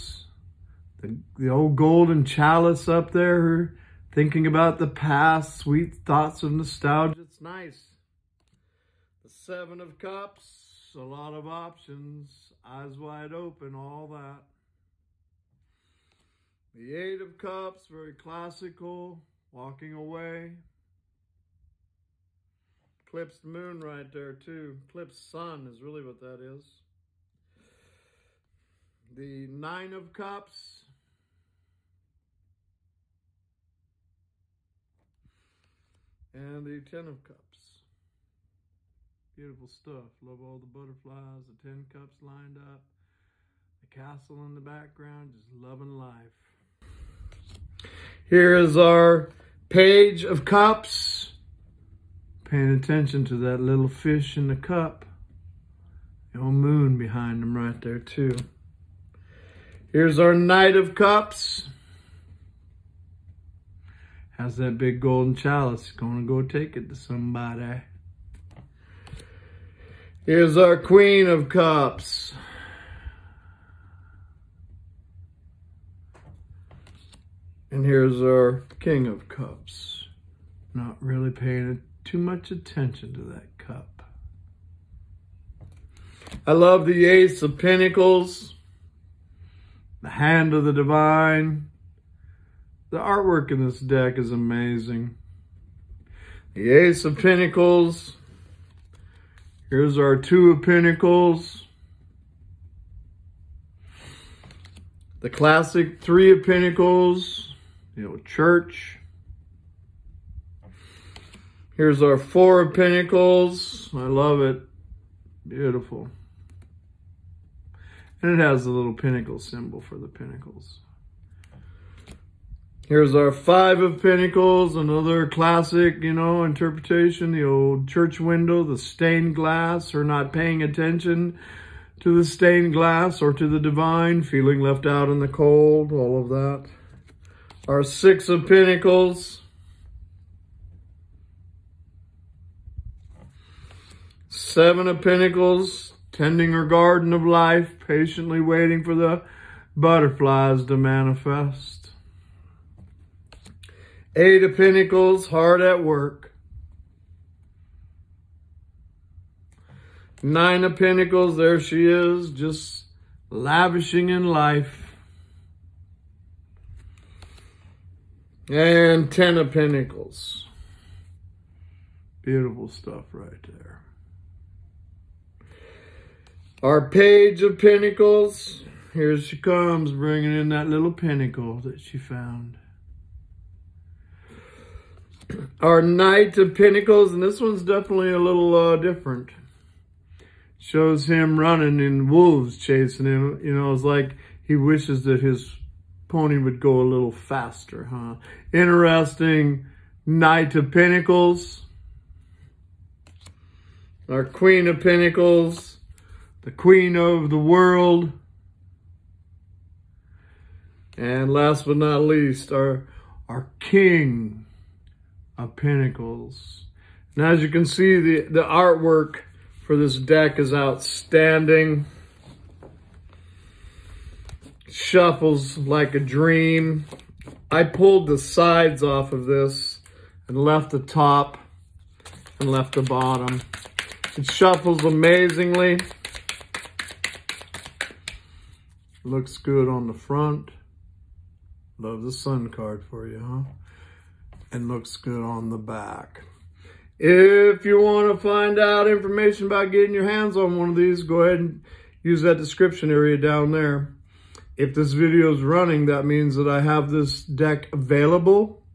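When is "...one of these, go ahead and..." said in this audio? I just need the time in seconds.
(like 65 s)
250 s.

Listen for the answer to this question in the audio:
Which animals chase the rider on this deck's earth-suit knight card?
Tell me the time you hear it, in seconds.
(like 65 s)
192 s.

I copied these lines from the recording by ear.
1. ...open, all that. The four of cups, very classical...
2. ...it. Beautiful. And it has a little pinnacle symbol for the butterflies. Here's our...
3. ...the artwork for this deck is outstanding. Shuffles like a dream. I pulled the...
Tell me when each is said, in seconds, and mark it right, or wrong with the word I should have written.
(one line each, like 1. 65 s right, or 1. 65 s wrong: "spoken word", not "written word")
1. 13 s wrong: "eight", not "four"
2. 114 s wrong: "pinnacles", not "butterflies"
3. 218 s right.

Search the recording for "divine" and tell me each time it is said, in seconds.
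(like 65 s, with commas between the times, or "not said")
90 s, 133 s.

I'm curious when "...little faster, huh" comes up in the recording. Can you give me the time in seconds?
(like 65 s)
196 s.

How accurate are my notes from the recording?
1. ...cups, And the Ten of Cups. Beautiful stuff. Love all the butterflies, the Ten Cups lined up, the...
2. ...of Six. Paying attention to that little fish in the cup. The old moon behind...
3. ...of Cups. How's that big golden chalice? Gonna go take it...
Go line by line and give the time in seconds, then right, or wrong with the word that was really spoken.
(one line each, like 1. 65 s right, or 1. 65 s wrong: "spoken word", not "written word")
1. 30 s right
2. 50 s wrong: "Cups", not "Six"
3. 60 s right.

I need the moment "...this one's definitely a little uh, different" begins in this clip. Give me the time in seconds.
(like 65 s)
187 s.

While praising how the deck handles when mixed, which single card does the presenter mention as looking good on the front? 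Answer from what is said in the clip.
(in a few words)
The Sun.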